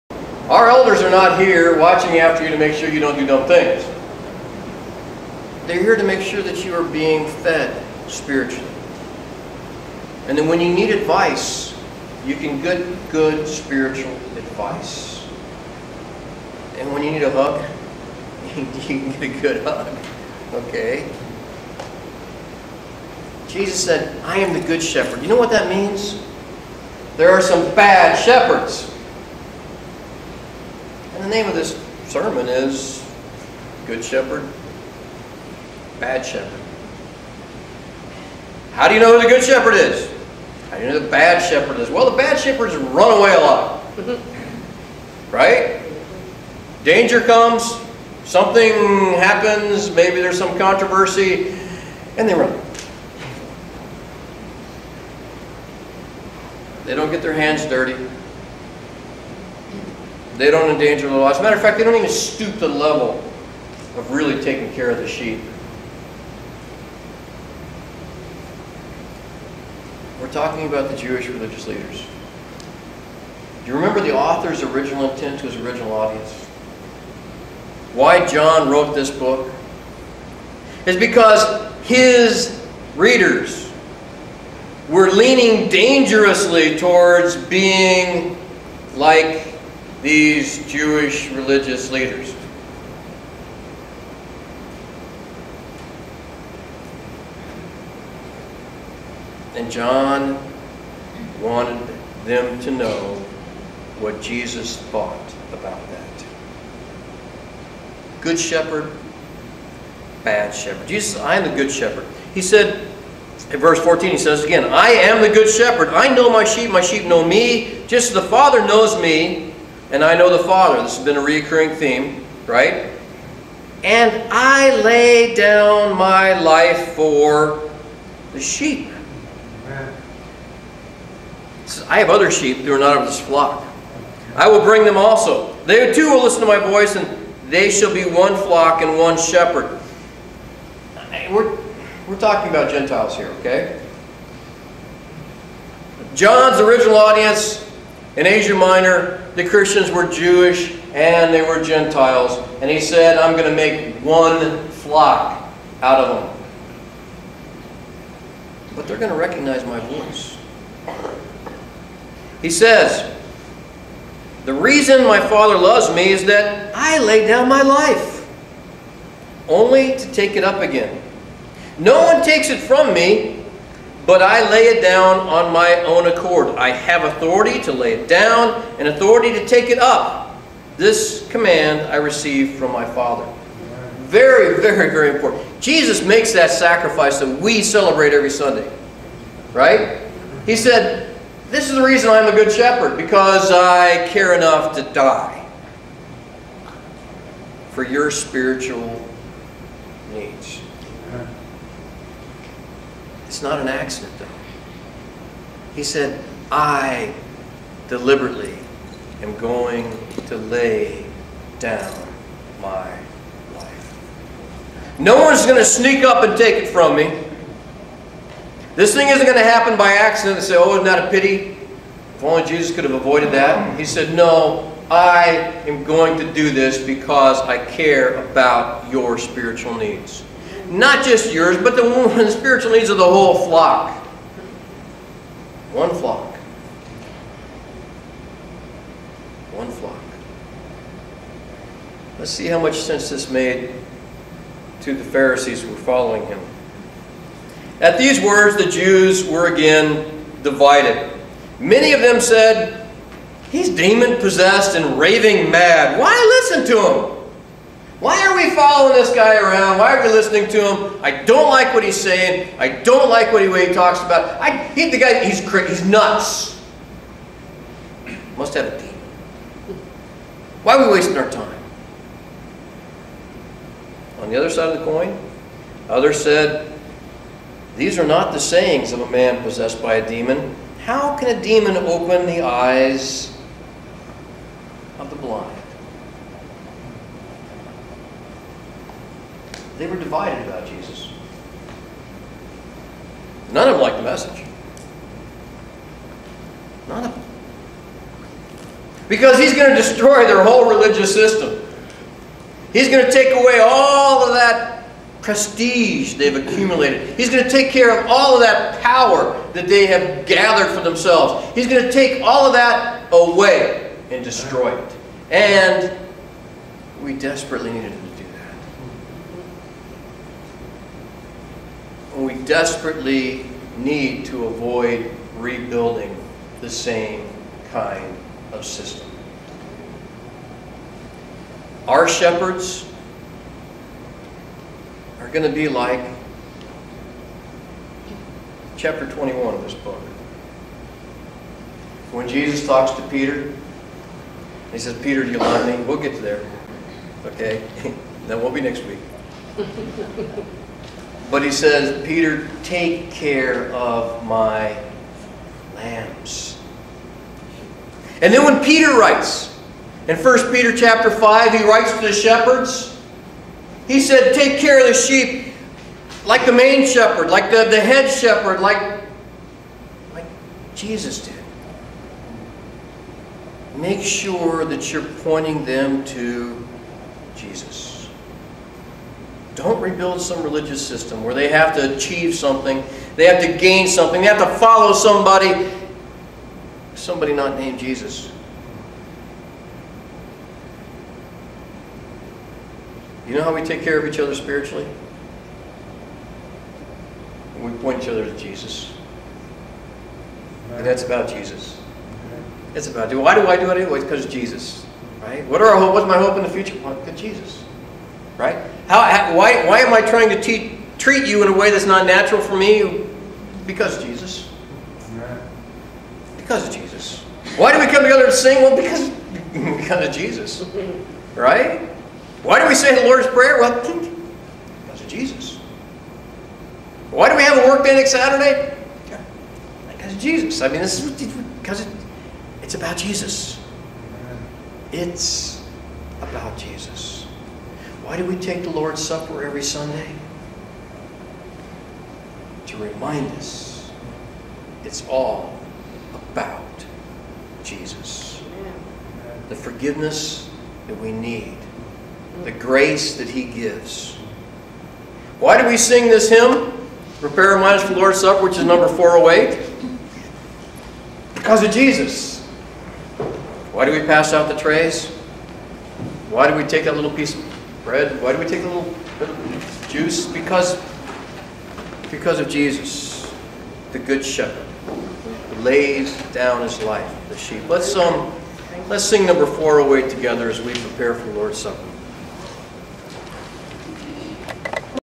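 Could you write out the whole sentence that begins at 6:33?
You know how we take care of each other spiritually?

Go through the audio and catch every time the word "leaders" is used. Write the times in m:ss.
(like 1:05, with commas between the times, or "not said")
1:11, 1:31.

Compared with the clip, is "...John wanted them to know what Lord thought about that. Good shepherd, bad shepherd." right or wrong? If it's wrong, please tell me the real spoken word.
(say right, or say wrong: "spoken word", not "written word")
wrong: "Jesus", not "Lord".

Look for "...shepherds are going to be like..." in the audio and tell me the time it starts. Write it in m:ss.
5:32.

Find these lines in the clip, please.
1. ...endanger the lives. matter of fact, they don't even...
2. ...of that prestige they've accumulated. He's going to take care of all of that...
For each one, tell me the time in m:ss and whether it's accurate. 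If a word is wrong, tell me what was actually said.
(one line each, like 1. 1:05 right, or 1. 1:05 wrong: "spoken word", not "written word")
1. 1:00 right
2. 5:04 right.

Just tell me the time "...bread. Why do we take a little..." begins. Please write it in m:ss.
7:47.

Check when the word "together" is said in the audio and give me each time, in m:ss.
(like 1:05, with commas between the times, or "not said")
6:58, 8:00.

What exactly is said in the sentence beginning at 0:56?
They don't get their hands dirty.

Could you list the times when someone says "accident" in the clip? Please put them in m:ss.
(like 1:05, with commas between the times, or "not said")
3:23, 3:39.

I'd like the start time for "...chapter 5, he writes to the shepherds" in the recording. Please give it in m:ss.
6:00.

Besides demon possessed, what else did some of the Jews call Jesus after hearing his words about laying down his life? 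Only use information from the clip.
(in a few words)
Raving mad.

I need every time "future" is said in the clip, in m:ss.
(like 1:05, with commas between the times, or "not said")
6:46.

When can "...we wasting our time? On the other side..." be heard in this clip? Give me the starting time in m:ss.
4:30.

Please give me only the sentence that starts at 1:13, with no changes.
Do you remember the author's original intent to his original audience?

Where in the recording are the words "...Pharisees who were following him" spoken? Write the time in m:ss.
4:05.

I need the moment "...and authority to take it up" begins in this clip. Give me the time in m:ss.
2:58.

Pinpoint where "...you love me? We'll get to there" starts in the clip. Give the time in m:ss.
5:45.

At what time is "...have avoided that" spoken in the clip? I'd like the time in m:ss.
3:42.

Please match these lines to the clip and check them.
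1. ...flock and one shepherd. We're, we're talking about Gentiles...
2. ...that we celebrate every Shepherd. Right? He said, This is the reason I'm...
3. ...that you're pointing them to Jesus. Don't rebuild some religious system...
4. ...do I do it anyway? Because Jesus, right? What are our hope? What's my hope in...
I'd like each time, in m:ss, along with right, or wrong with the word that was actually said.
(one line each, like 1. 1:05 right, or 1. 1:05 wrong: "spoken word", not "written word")
1. 2:18 right
2. 3:07 wrong: "Sunday", not "Shepherd"
3. 6:14 right
4. 6:43 right.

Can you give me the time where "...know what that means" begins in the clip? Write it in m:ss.
0:25.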